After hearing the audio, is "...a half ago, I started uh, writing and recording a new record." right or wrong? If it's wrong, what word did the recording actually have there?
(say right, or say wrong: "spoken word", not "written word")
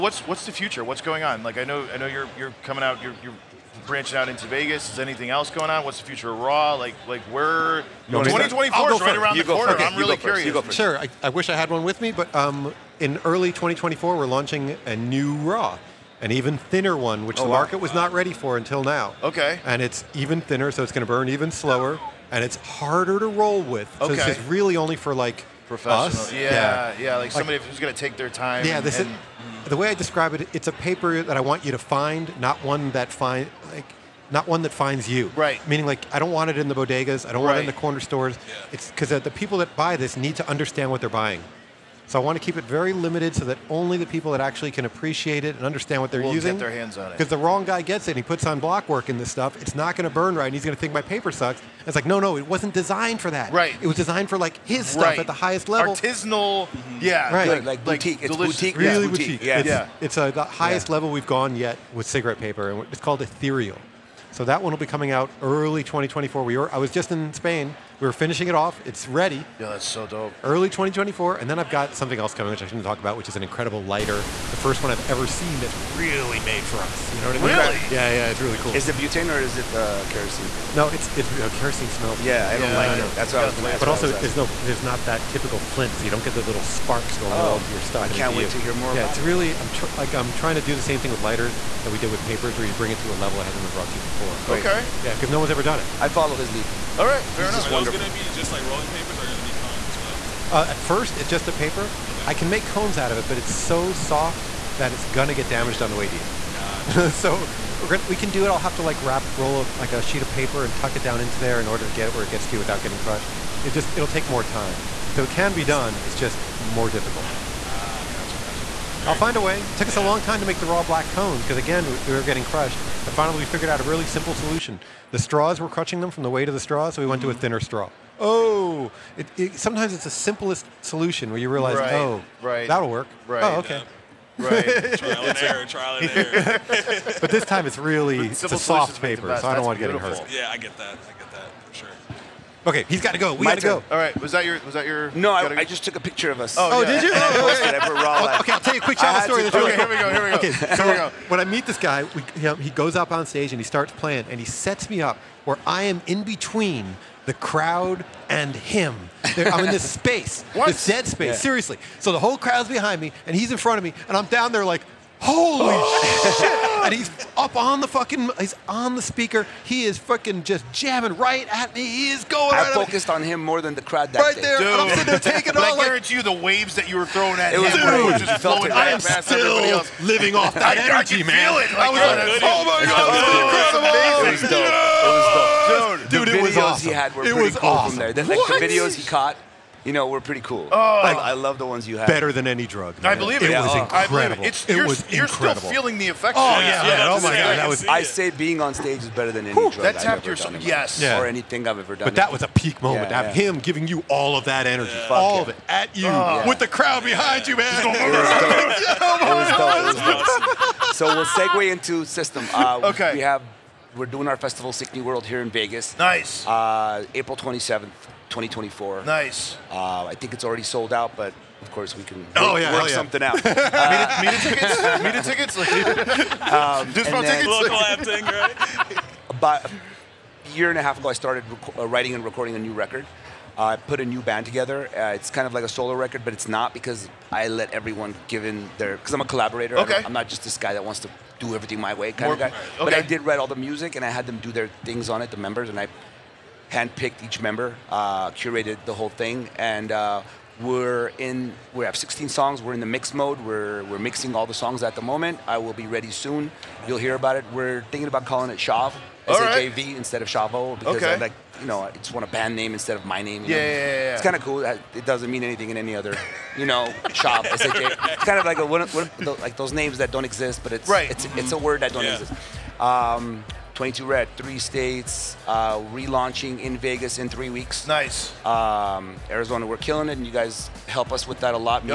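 right.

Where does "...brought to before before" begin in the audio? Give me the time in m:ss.
1:33.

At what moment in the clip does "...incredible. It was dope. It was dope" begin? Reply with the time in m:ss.
3:04.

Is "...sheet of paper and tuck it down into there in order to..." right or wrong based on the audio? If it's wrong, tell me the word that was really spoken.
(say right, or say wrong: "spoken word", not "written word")
right.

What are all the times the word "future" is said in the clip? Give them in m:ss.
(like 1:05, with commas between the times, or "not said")
0:00, 0:06.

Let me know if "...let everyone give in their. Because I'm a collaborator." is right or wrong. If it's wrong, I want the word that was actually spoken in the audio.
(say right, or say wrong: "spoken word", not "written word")
right.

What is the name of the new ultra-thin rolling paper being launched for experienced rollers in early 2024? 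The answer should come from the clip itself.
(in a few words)
Ethereal.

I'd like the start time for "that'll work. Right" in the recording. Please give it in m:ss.
2:12.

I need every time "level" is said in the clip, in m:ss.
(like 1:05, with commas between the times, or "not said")
0:55, 1:00, 1:33.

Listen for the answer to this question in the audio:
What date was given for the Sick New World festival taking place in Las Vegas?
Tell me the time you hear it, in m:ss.
3:37.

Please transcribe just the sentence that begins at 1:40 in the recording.
Uh, at first, it's just a paper.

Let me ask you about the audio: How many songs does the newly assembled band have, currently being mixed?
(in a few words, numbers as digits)
16.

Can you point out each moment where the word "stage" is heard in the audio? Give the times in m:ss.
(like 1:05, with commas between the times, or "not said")
2:33, 3:18.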